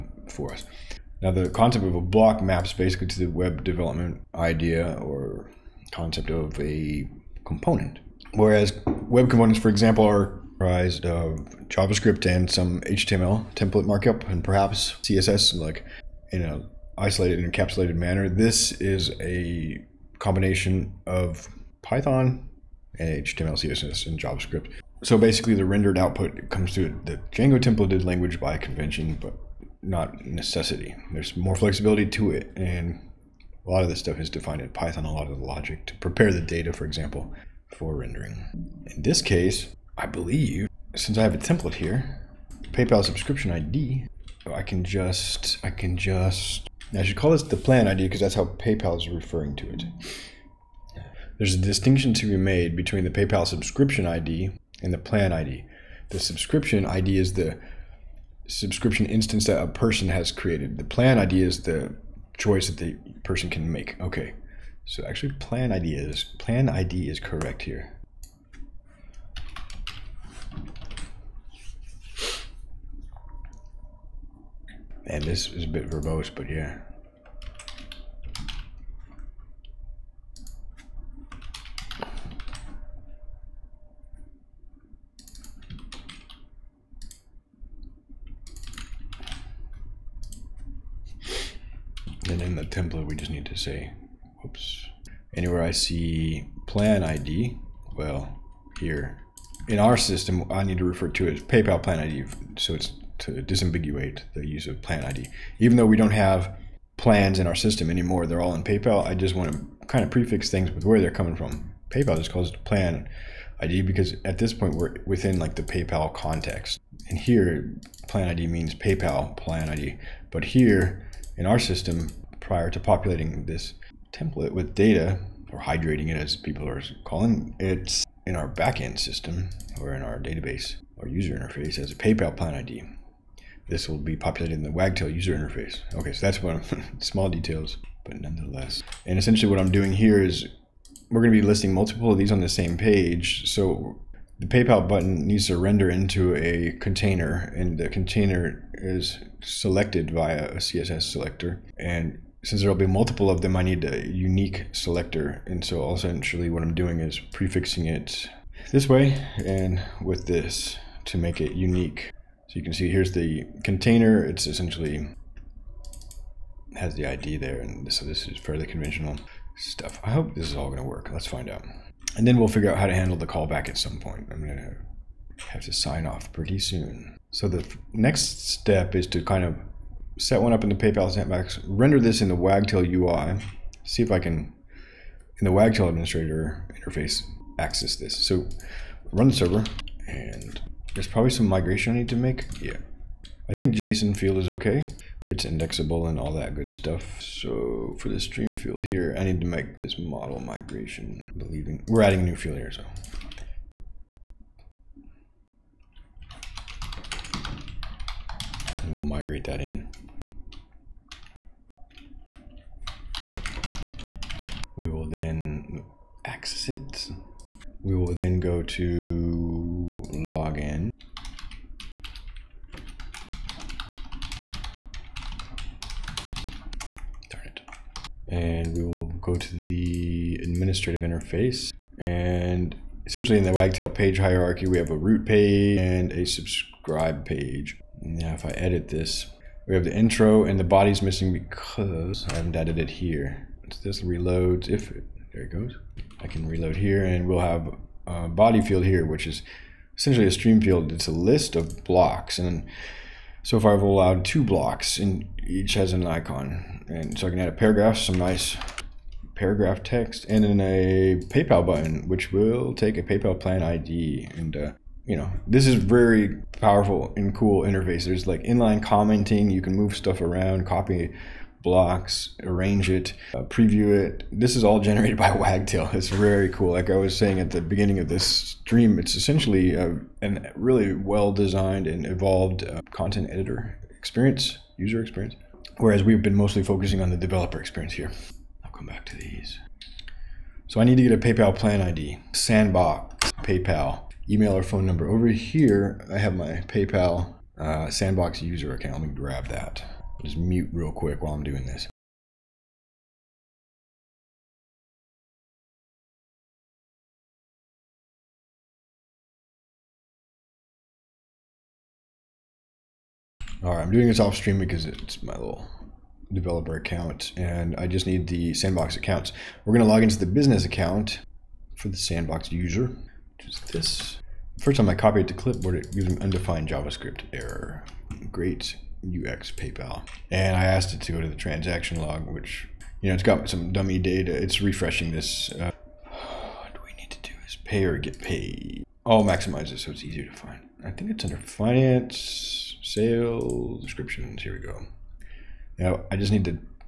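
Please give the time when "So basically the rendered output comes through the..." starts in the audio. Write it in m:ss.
0:25.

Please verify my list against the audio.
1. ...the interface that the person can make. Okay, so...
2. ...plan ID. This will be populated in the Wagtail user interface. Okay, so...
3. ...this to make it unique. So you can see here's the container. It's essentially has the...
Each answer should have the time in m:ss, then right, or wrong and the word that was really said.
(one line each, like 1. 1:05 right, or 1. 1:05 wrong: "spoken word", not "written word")
1. 1:01 wrong: "choice", not "interface"
2. 2:12 right
3. 2:40 right.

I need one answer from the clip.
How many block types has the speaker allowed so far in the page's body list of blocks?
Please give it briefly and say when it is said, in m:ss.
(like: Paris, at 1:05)
2, at 4:14.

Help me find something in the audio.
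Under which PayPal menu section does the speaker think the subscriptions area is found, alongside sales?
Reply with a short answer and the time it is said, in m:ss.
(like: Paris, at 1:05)
finance, at 5:41.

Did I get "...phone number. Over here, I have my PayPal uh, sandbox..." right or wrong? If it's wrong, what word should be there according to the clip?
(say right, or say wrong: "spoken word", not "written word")
right.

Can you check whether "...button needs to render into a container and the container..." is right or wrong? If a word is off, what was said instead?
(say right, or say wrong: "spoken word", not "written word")
right.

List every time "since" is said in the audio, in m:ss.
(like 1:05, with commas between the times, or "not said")
0:40, 2:32.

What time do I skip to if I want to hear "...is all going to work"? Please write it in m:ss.
2:50.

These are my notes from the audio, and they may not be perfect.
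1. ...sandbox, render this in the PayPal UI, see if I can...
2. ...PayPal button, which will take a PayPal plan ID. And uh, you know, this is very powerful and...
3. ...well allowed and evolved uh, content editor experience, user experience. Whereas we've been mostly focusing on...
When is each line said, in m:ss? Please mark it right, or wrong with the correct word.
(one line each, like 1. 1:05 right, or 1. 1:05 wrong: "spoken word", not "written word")
1. 3:01 wrong: "Wagtail", not "PayPal"
2. 4:21 right
3. 4:40 wrong: "designed", not "allowed".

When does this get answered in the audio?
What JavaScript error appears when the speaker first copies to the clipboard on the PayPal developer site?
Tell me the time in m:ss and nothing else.
5:26.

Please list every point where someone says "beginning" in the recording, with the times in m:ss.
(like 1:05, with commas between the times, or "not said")
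4:37.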